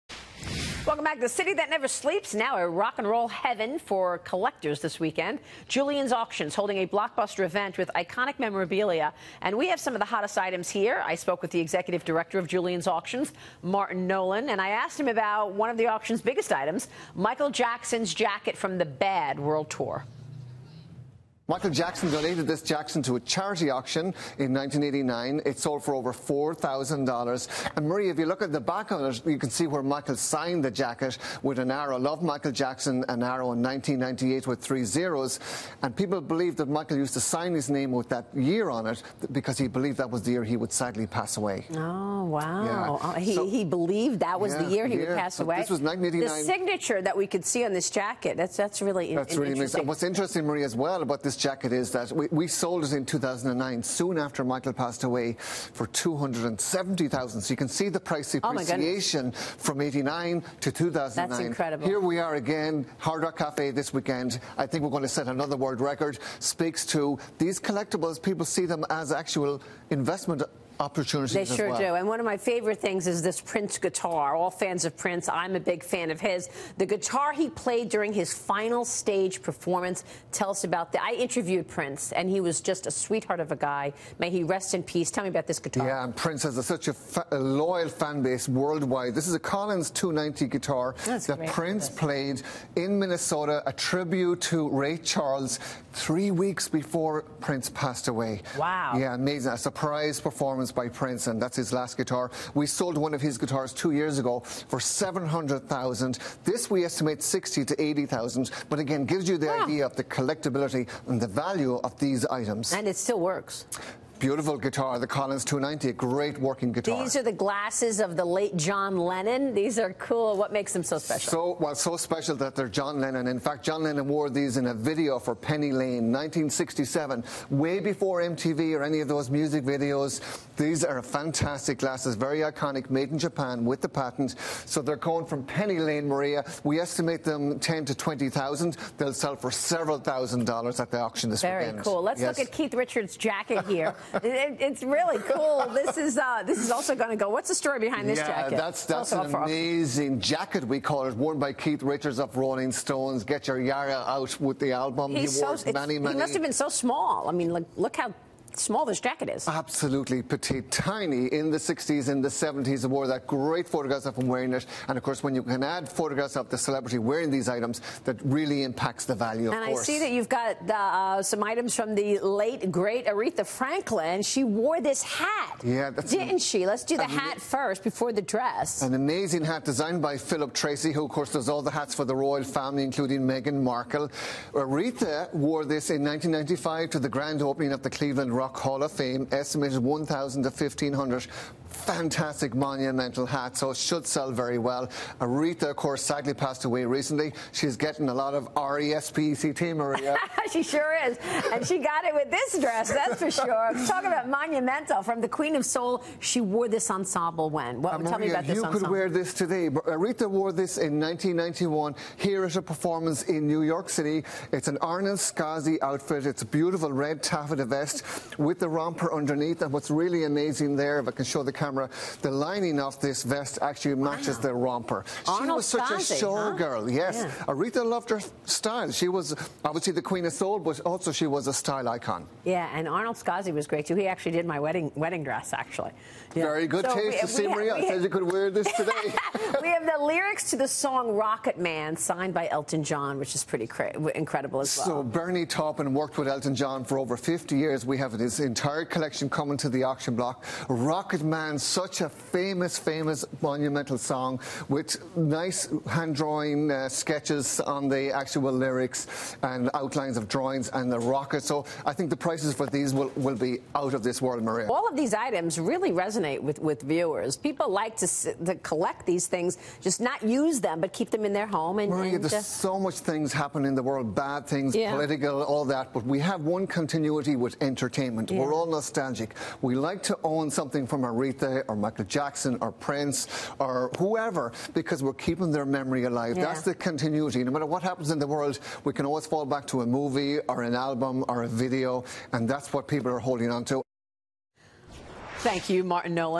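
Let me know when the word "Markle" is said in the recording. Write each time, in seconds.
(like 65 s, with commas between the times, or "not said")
183 s.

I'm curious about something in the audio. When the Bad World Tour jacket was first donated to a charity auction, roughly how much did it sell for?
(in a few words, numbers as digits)
over $4,000.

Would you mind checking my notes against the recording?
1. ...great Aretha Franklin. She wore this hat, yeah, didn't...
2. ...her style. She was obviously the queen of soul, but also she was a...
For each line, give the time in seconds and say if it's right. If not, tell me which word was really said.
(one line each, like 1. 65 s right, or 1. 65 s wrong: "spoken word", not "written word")
1. 172 s right
2. 228 s right.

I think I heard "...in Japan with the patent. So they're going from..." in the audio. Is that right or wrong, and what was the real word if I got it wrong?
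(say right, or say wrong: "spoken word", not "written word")
right.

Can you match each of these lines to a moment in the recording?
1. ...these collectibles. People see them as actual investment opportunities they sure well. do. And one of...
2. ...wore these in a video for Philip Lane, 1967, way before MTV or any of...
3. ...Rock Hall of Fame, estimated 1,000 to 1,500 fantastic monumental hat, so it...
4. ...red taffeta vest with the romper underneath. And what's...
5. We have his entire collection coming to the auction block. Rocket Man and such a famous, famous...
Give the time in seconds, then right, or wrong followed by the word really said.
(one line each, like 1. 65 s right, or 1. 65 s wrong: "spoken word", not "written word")
1. 67 s right
2. 124 s wrong: "Penny", not "Philip"
3. 188 s right
4. 216 s right
5. 247 s right.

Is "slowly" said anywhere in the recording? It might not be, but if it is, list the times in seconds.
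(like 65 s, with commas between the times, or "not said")
not said.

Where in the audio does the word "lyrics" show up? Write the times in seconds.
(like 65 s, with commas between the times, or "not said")
240 s, 258 s.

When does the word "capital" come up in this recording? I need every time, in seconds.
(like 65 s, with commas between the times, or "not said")
not said.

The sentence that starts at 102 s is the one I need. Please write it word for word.
We sold one of his guitars two years ago for 700,000.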